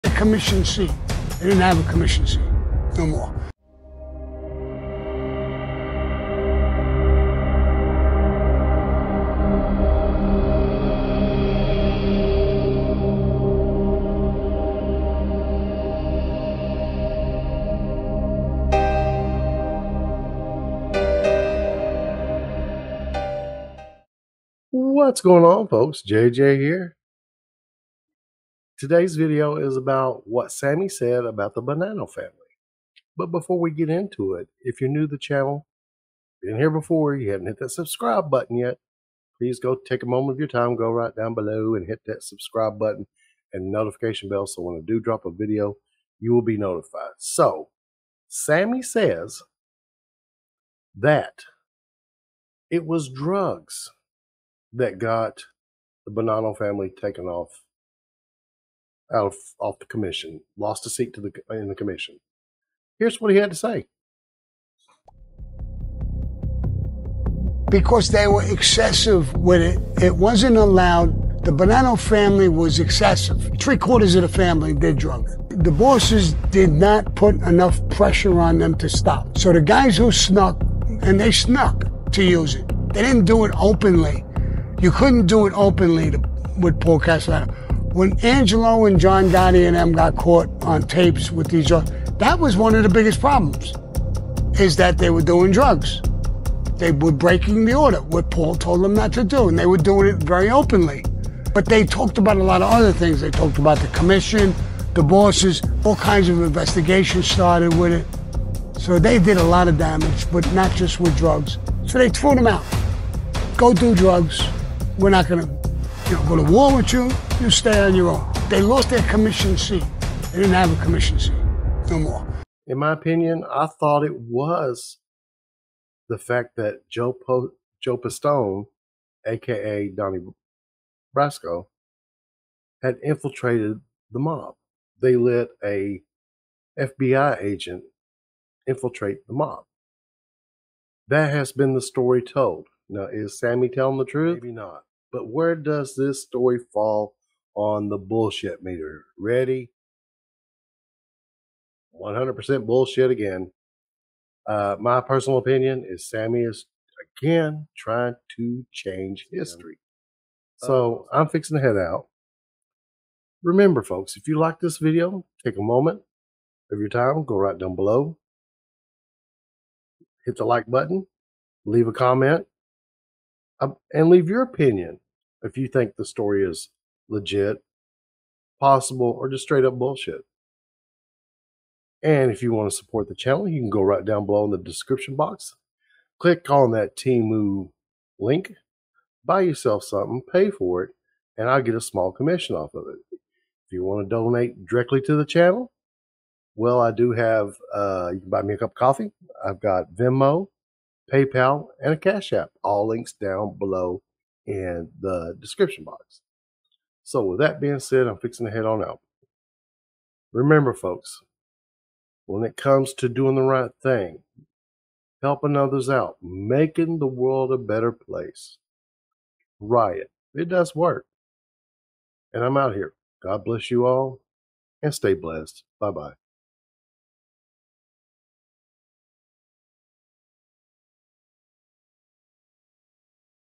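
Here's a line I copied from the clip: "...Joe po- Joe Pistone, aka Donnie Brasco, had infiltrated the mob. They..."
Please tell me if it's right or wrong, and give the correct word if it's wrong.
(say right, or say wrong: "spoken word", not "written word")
right.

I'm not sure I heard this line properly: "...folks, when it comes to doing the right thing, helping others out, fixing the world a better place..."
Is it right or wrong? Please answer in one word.
wrong.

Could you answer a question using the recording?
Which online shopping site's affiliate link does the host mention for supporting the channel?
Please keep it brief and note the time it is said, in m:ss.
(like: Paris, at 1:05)
Temu, at 3:06.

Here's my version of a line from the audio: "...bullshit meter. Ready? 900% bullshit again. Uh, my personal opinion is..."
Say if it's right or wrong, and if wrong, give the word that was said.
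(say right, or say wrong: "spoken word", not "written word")
wrong: "100", not "900".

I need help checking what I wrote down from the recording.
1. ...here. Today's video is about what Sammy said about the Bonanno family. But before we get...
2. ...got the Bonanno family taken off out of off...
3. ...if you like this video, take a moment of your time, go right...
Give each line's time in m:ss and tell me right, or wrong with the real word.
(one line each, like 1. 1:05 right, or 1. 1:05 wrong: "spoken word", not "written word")
1. 0:26 right
2. 0:54 right
3. 2:44 right.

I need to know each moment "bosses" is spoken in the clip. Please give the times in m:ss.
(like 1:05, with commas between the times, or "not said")
1:15, 1:45.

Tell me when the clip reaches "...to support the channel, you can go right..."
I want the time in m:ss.
3:02.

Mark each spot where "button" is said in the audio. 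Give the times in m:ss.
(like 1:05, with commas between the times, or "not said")
0:38, 0:42, 2:50.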